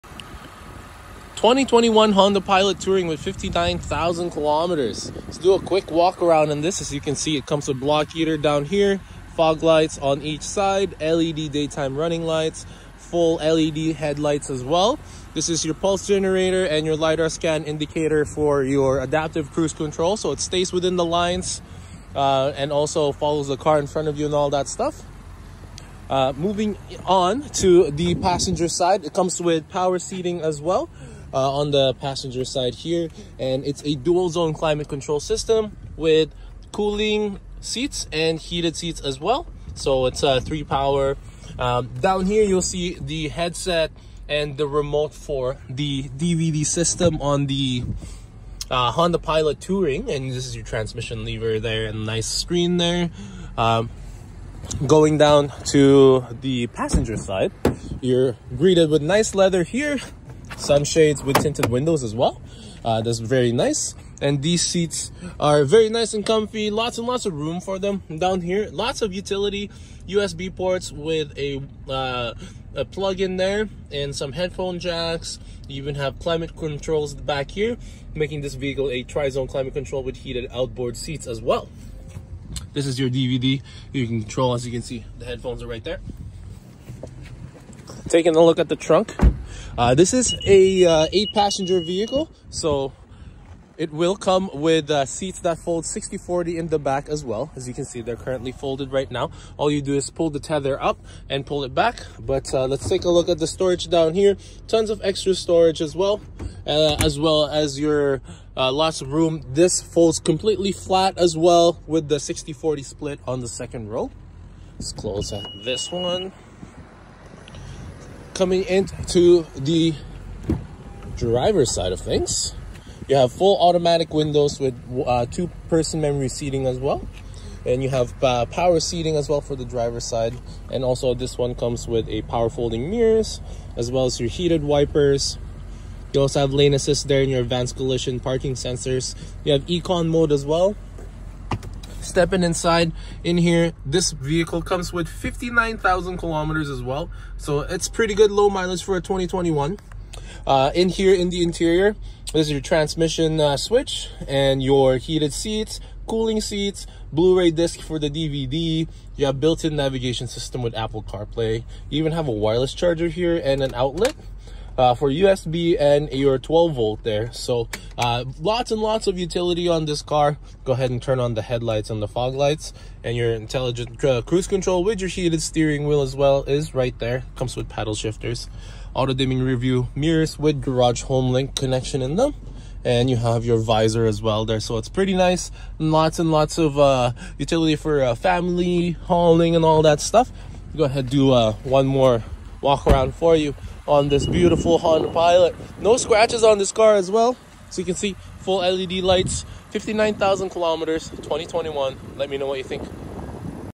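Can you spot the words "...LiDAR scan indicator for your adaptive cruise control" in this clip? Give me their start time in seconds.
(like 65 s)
16 s.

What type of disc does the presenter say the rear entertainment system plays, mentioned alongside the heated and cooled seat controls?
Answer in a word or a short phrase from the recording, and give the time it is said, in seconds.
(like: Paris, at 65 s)
Blu-ray, at 157 s.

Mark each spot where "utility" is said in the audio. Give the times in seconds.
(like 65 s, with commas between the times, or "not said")
69 s, 169 s, 187 s.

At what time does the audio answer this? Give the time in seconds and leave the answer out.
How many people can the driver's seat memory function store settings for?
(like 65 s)
125 s.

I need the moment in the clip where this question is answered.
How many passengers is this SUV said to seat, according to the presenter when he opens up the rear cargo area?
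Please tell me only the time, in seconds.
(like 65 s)
91 s.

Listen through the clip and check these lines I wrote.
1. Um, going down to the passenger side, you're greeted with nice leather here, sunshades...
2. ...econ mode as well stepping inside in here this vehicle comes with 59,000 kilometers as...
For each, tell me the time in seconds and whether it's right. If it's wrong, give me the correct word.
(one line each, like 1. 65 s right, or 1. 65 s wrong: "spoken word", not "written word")
1. 53 s right
2. 139 s right.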